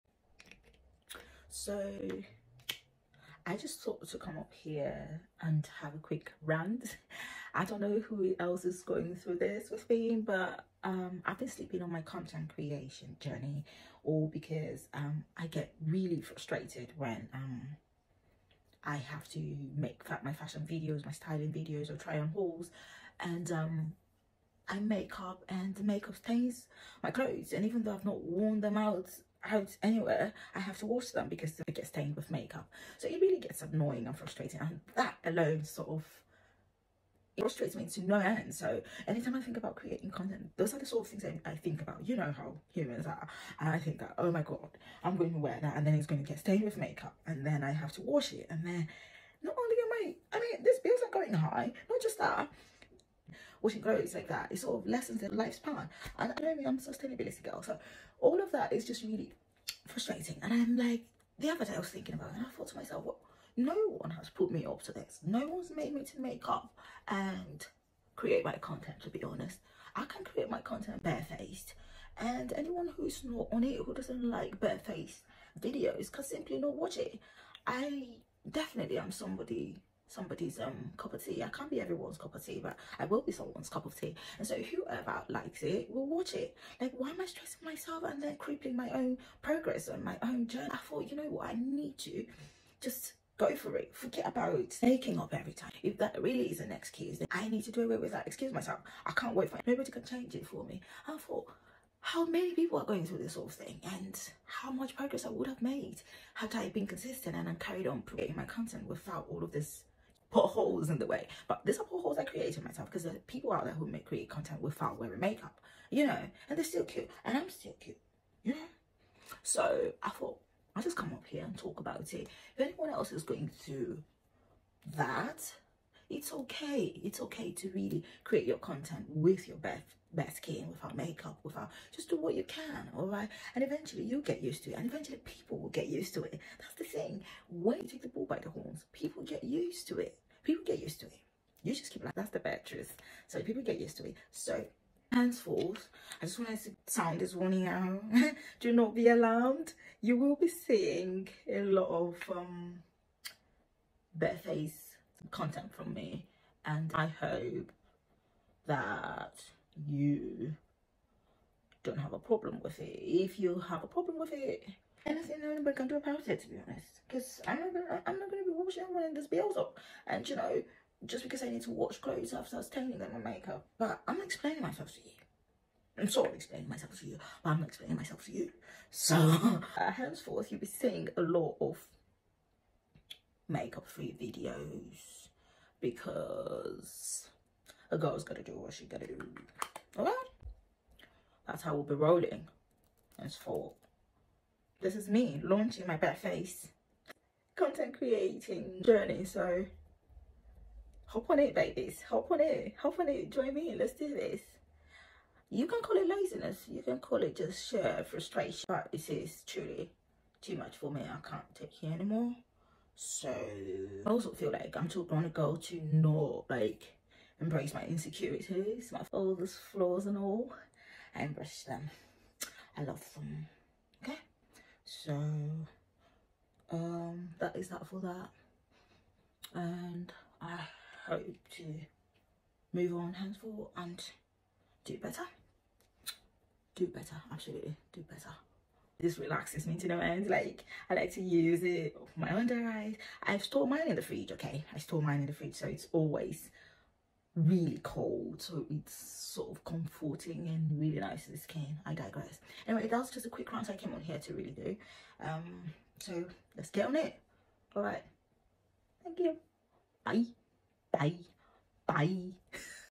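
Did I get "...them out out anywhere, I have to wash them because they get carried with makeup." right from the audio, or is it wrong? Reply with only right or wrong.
wrong.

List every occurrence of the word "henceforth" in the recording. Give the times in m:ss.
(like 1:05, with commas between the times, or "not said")
2:25, 2:59, 3:53.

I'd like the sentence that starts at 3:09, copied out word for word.
Okay, That's how we'll be rolling for.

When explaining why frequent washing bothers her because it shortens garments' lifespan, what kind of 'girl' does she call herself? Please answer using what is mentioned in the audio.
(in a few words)
sustainability girl.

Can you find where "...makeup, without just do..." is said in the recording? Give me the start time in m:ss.
2:10.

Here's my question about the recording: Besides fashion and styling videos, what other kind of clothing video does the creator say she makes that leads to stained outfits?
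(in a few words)
try on hauls.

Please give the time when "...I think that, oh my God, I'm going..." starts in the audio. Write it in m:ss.
0:43.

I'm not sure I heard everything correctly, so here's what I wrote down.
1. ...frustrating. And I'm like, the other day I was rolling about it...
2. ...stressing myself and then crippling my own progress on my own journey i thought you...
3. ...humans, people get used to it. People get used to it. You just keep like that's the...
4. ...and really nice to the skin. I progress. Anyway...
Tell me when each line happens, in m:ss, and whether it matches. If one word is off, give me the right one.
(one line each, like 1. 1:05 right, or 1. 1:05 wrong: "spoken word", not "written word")
1. 0:59 wrong: "thinking", not "rolling"
2. 1:27 right
3. 2:18 wrong: "horns", not "humans"
4. 4:10 wrong: "digress", not "progress".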